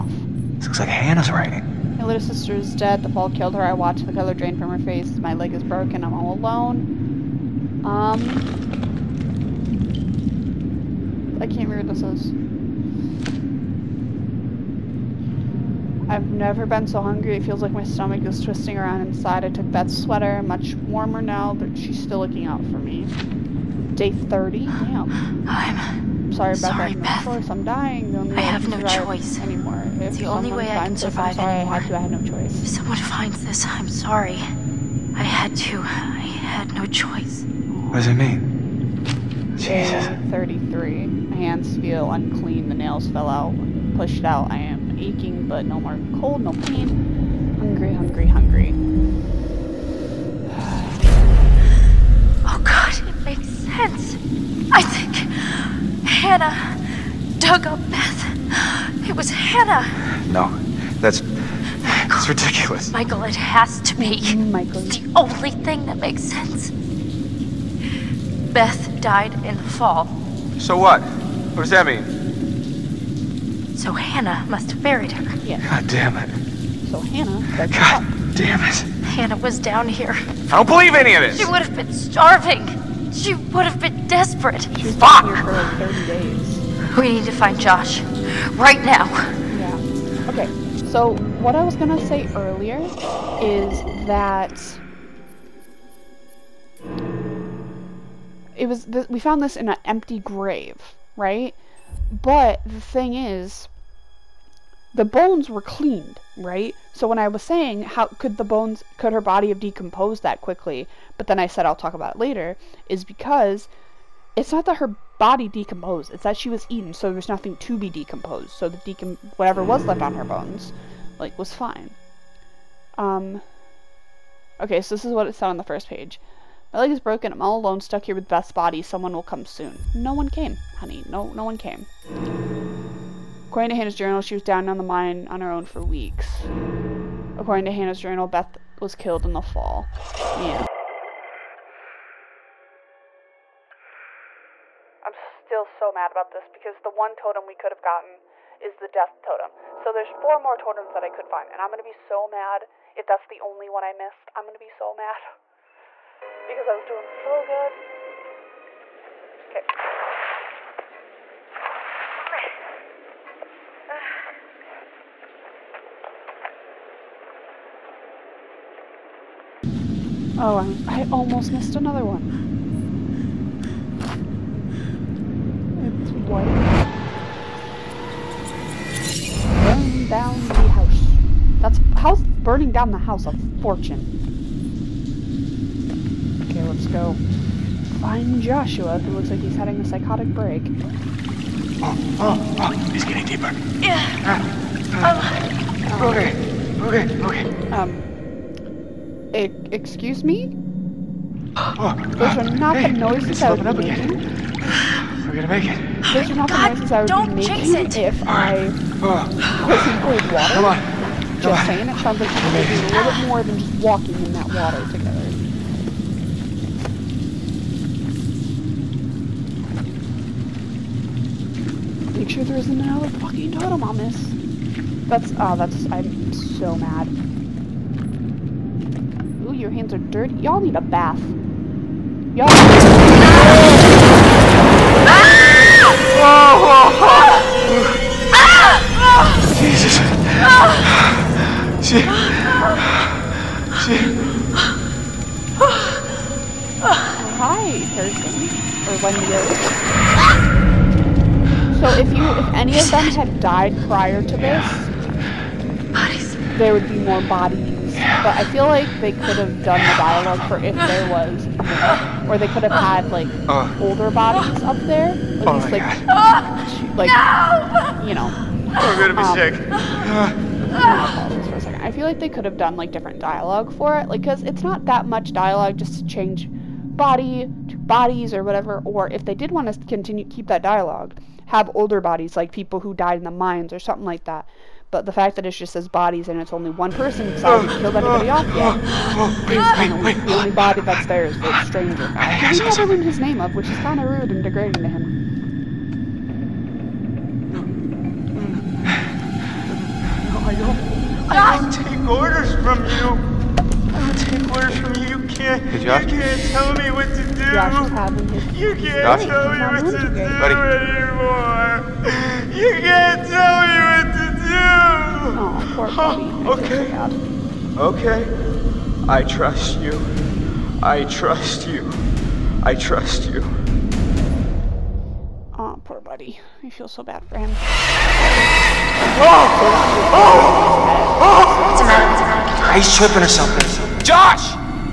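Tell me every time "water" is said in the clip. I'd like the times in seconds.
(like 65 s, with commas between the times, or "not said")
210 s, 214 s.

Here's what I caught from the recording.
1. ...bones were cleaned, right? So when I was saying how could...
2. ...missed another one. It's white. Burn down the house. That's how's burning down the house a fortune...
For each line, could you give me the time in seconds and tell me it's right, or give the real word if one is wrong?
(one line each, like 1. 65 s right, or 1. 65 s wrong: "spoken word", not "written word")
1. 105 s right
2. 171 s right.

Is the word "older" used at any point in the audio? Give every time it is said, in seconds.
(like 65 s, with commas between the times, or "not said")
263 s, 281 s.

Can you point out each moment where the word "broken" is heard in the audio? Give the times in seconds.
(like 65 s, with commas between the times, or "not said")
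5 s, 126 s.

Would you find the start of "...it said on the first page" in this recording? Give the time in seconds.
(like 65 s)
125 s.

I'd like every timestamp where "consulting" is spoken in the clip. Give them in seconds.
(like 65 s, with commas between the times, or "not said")
not said.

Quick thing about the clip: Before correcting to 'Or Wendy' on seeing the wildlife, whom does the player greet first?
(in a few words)
Thurston.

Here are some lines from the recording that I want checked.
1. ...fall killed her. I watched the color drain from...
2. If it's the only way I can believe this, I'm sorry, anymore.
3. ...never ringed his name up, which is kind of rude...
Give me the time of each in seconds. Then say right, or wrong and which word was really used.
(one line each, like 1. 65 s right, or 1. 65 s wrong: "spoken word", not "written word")
1. 3 s right
2. 29 s wrong: "survive", not "believe"
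3. 292 s right.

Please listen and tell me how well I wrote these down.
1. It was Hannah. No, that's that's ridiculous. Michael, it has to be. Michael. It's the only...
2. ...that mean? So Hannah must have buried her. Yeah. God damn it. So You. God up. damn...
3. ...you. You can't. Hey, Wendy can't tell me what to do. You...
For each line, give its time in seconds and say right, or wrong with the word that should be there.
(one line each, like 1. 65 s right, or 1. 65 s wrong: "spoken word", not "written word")
1. 59 s right
2. 71 s wrong: "Hannah", not "You"
3. 304 s wrong: "You", not "Wendy".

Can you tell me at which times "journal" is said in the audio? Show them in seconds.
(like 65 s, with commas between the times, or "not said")
133 s, 138 s.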